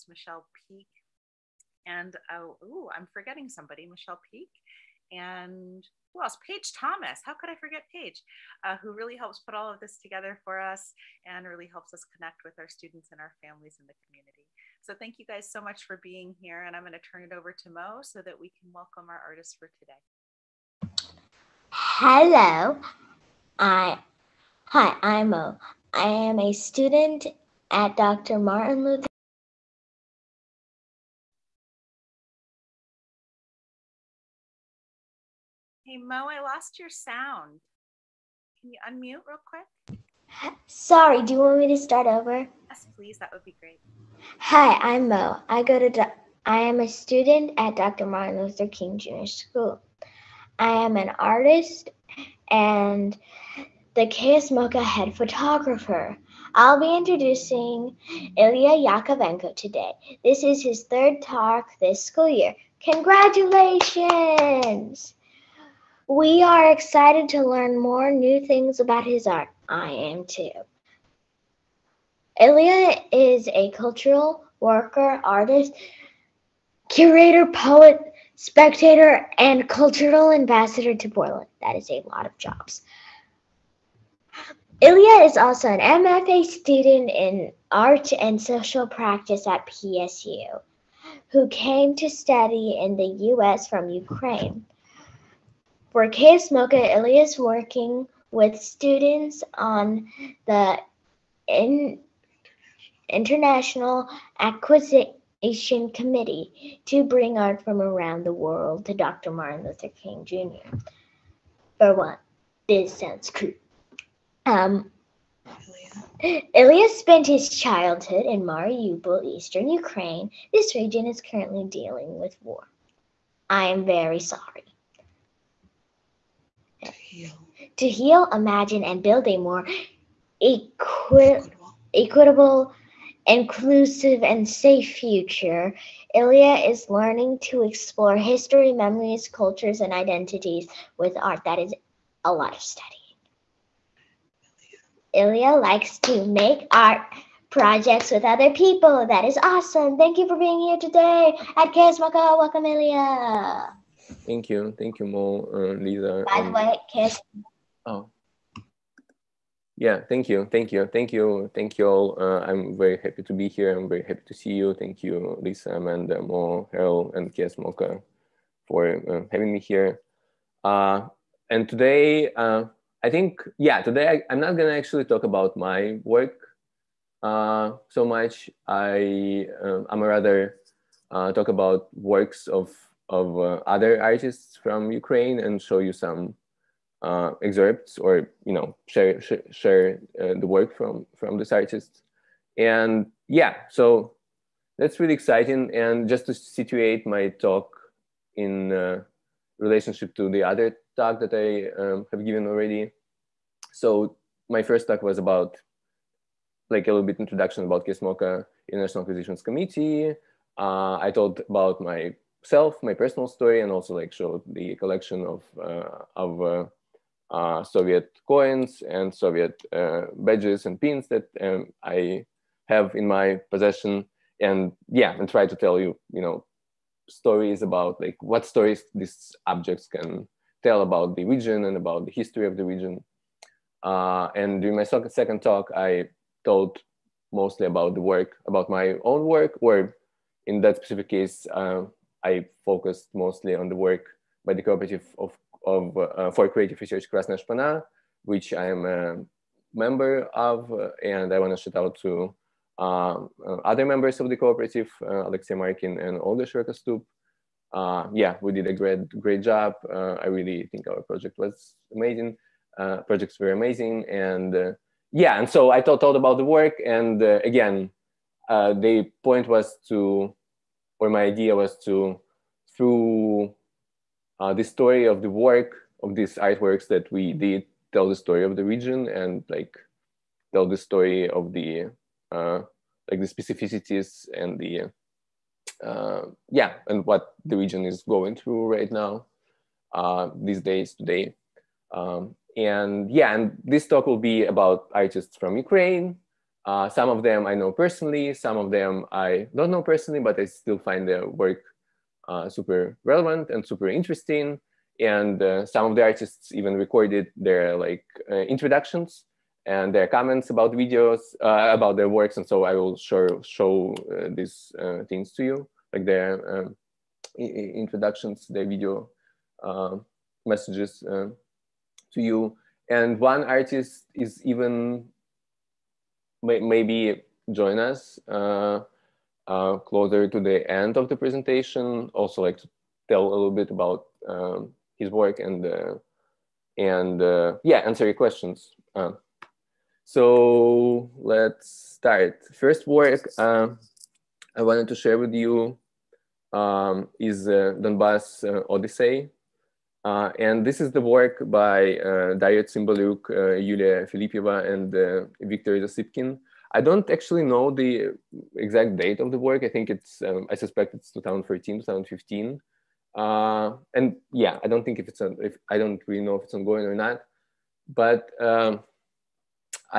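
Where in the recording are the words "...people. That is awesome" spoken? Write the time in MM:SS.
02:28.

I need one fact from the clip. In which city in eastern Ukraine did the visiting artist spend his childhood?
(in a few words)
Mariupol.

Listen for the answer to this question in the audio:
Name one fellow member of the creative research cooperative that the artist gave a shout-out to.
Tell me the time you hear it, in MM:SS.
04:15.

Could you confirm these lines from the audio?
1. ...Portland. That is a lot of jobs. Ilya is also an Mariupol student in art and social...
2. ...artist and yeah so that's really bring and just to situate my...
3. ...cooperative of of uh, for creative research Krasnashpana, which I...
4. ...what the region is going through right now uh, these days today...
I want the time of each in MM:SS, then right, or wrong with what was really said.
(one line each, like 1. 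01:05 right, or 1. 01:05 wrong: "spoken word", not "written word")
1. 01:21 wrong: "MFA", not "Mariupol"
2. 03:11 wrong: "exciting", not "bring"
3. 04:04 right
4. 04:47 right.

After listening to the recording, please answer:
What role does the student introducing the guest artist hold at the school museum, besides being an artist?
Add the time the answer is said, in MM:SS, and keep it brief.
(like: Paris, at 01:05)
Head photographer, at 00:54.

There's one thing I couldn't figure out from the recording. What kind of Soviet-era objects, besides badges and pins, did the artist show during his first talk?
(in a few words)
Coins.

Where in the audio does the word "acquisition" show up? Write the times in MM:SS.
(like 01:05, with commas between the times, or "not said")
01:44, 03:29.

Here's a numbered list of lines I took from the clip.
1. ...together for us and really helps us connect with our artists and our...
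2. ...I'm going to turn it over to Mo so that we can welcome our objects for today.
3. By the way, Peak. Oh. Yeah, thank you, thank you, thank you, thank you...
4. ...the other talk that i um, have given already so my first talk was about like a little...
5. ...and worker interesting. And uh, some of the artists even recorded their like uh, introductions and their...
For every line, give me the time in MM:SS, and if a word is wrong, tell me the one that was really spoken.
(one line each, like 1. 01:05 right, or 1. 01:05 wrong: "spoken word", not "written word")
1. 00:10 wrong: "students", not "artists"
2. 00:16 wrong: "artists", not "objects"
3. 02:36 wrong: "Chaos", not "Peak"
4. 03:20 right
5. 05:03 wrong: "super", not "worker".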